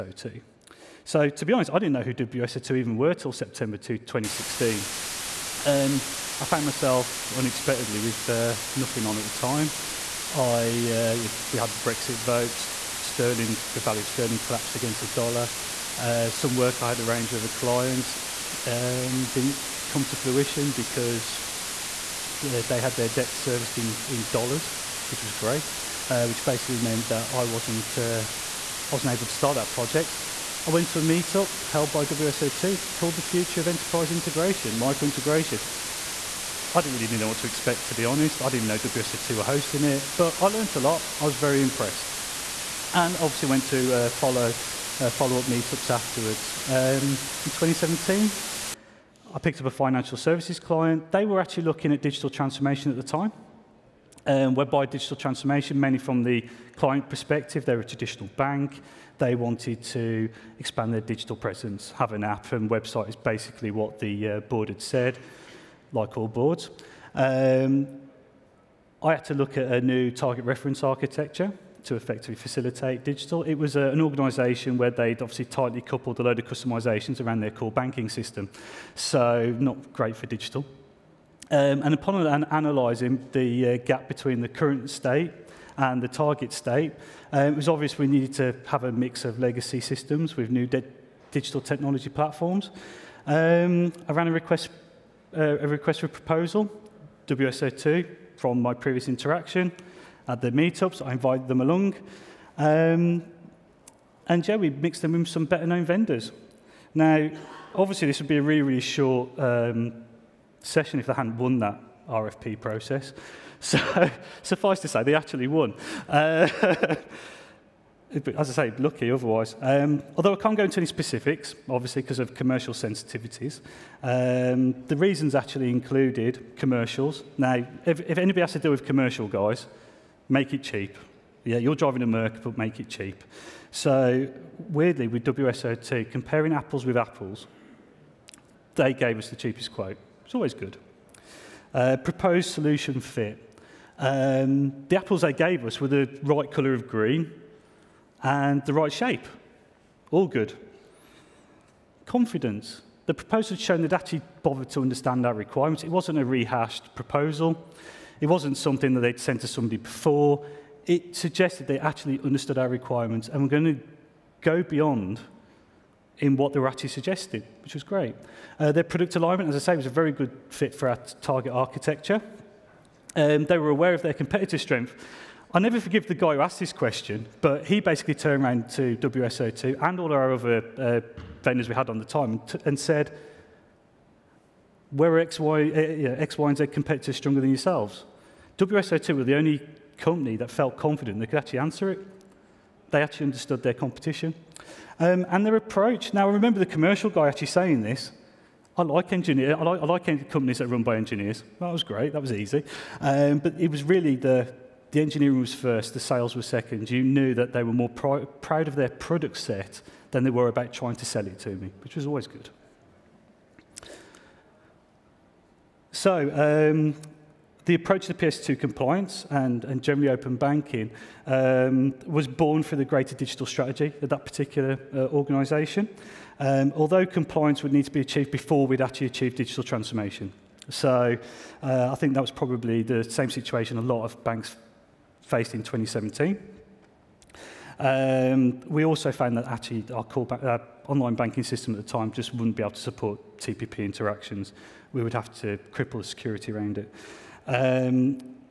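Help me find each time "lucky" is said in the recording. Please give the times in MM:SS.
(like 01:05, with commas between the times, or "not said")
01:58.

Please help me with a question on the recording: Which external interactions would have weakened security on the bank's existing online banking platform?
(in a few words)
TPP interactions.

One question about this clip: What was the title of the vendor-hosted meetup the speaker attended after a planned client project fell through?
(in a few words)
The Future of Enterprise Integration.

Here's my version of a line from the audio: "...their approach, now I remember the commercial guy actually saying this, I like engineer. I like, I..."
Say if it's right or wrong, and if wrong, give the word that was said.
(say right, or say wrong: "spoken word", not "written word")
right.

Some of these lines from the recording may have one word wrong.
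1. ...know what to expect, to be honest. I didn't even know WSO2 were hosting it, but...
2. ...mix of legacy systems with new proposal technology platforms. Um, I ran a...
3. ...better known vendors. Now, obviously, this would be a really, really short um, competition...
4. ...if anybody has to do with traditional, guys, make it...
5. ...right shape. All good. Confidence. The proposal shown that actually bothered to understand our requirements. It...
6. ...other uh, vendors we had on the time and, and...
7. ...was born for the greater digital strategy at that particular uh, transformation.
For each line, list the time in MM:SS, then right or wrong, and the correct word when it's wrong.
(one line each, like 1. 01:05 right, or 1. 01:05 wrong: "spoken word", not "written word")
1. 00:37 right
2. 01:28 wrong: "digital", not "proposal"
3. 01:45 wrong: "session", not "competition"
4. 02:08 wrong: "commercial", not "traditional"
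5. 02:28 right
6. 03:00 right
7. 03:42 wrong: "organization", not "transformation".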